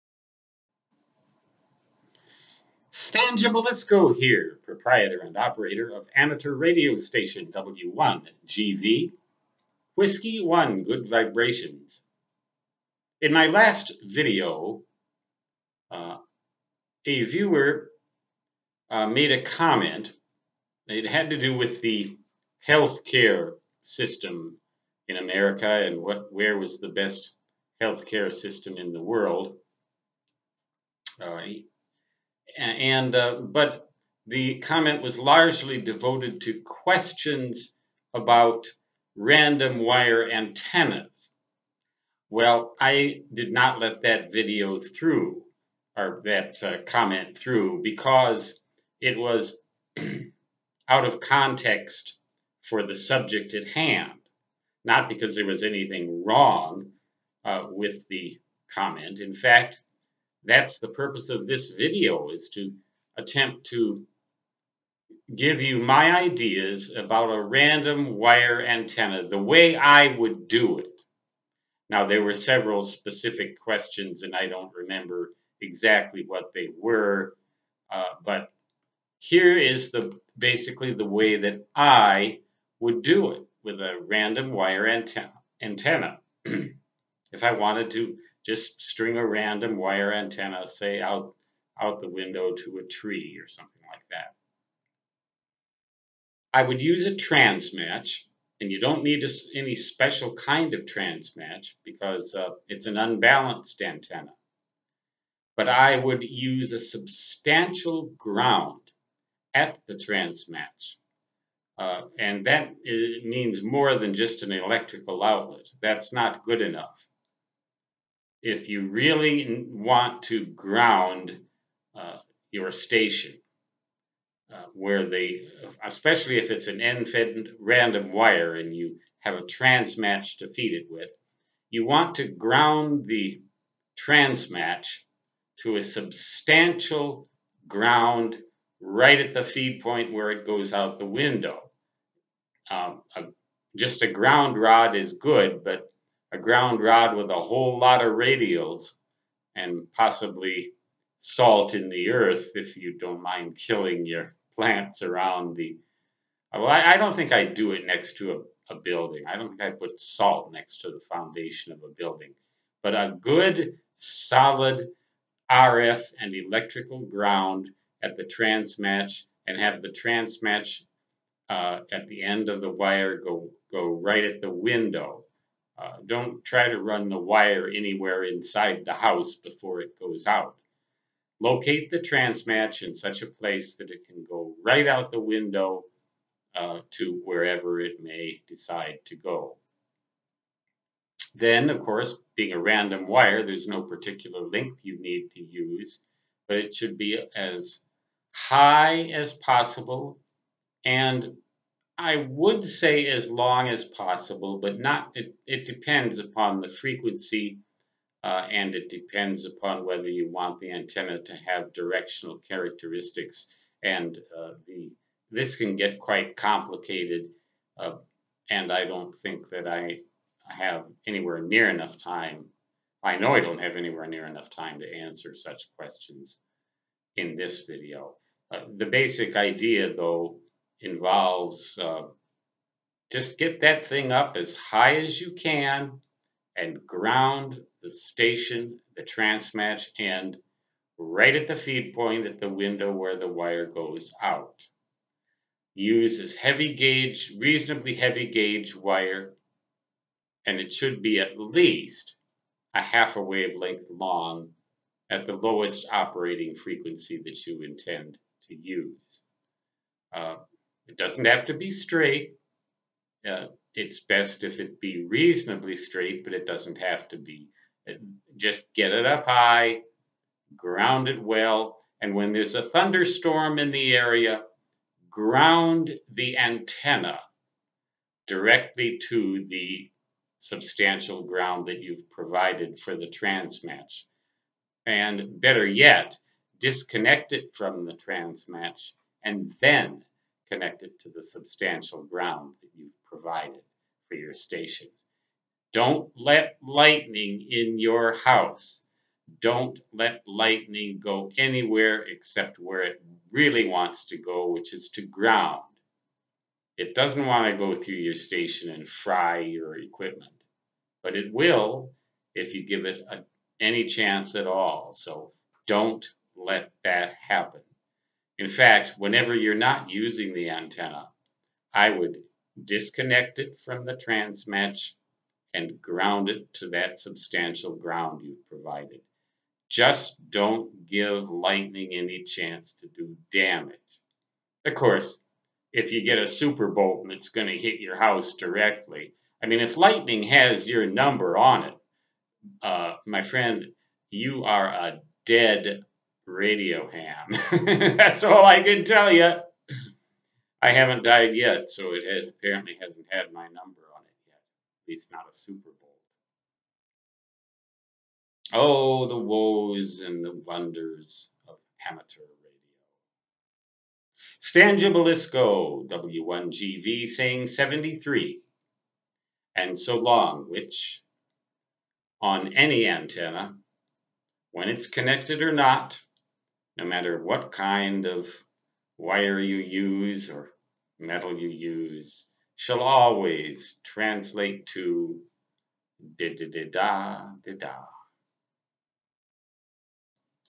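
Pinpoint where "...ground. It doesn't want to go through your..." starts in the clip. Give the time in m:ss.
5:05.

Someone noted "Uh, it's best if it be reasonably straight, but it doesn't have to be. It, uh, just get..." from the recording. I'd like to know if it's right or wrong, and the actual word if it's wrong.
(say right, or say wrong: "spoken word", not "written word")
right.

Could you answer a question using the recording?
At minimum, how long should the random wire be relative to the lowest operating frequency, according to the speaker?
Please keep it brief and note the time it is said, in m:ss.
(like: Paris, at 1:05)
half a wavelength, at 4:12.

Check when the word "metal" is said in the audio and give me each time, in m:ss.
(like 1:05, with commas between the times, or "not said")
6:20.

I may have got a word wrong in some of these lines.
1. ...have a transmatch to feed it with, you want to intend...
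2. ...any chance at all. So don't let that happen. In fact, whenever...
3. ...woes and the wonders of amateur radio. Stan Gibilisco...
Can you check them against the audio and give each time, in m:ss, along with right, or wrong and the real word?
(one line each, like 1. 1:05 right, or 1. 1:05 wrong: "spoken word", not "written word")
1. 2:09 wrong: "ground", not "intend"
2. 5:13 right
3. 5:59 right.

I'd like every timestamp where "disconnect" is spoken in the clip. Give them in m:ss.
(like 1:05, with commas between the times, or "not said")
4:46, 5:22.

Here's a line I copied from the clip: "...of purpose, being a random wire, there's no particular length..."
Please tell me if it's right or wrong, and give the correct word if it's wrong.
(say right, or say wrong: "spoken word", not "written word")
wrong: "course", not "purpose".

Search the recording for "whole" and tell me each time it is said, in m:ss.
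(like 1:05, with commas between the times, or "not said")
2:27.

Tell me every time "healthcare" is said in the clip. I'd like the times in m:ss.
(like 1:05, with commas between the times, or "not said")
0:22, 0:27.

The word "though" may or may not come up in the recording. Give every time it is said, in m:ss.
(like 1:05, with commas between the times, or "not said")
3:49.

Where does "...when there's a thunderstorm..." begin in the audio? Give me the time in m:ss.
4:32.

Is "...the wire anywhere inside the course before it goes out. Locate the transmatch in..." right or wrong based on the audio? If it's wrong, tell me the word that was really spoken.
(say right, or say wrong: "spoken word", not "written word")
wrong: "house", not "course".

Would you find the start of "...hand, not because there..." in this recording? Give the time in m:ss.
0:53.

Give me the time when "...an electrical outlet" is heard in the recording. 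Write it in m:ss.
1:54.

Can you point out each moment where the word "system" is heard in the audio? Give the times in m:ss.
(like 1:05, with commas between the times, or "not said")
0:23, 0:28.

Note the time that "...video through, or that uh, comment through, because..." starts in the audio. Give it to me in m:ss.
0:44.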